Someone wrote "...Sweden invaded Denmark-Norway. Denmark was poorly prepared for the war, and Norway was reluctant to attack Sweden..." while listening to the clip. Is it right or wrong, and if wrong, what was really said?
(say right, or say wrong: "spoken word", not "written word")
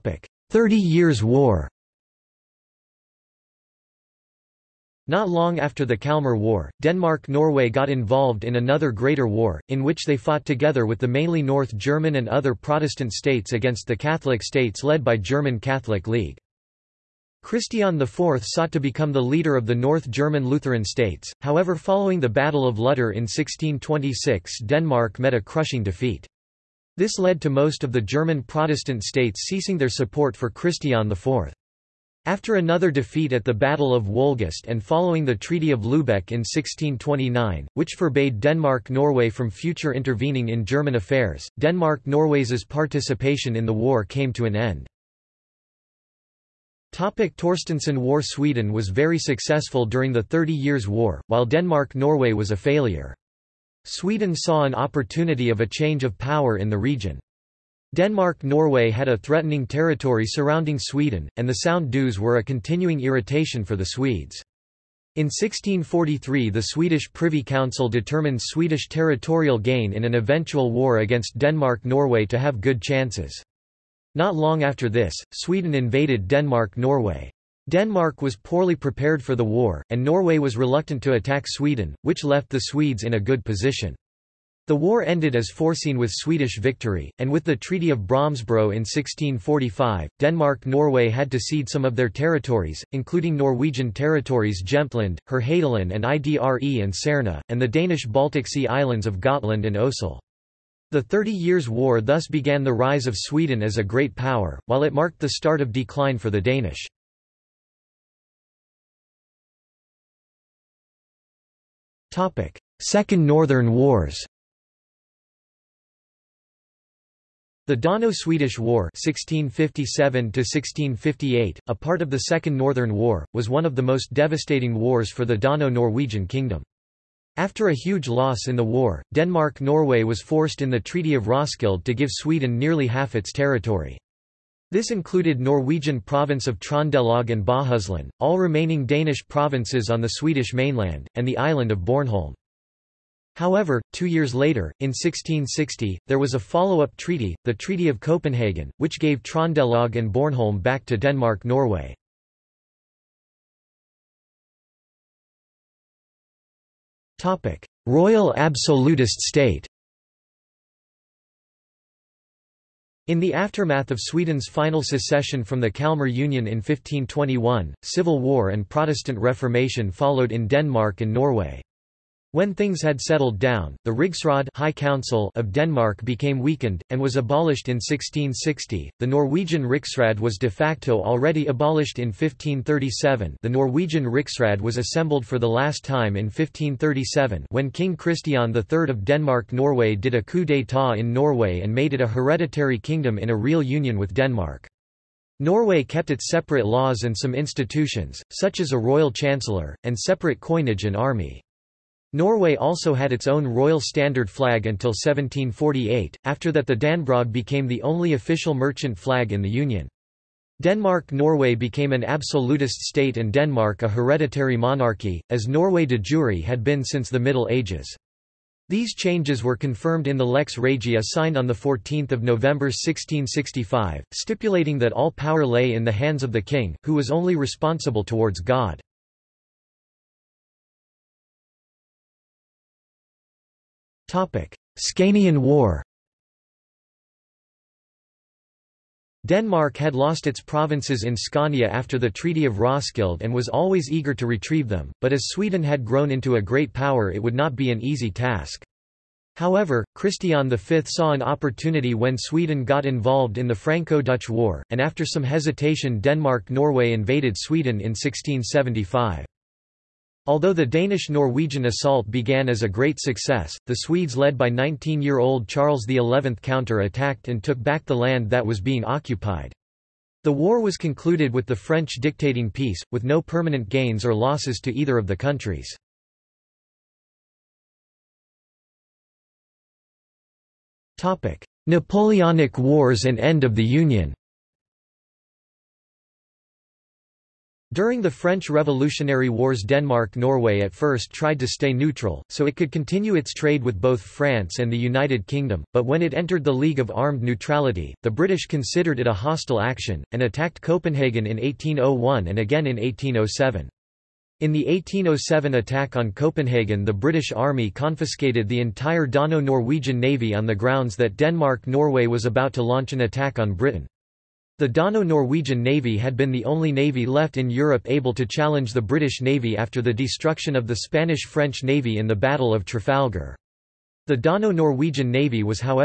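right.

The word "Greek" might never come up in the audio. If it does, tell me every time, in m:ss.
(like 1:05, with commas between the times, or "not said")
not said.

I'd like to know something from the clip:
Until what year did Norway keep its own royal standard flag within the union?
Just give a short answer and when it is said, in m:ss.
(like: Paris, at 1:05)
1748, at 3:24.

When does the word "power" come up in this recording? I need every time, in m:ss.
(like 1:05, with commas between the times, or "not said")
0:56, 1:44, 3:45, 4:06.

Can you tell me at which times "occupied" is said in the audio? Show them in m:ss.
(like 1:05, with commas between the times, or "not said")
4:28.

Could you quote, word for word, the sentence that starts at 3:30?
Denmark-Norway became an absolutist state and Denmark a hereditary monarchy, as Norway de jure had been since the Middle Ages.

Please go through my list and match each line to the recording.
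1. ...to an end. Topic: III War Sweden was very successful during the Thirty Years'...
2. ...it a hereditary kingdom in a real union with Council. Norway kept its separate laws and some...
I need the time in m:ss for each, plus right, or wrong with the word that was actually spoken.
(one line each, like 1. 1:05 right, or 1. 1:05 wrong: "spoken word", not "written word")
1. 0:44 wrong: "Torstenson", not "III"
2. 3:11 wrong: "Denmark", not "Council".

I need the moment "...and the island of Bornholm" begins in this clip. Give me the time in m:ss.
2:21.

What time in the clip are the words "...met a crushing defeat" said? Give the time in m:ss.
0:25.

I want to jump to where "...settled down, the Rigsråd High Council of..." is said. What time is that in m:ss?
2:52.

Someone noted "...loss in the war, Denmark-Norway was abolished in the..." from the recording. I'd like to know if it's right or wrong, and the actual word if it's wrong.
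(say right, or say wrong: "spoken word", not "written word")
wrong: "forced", not "abolished".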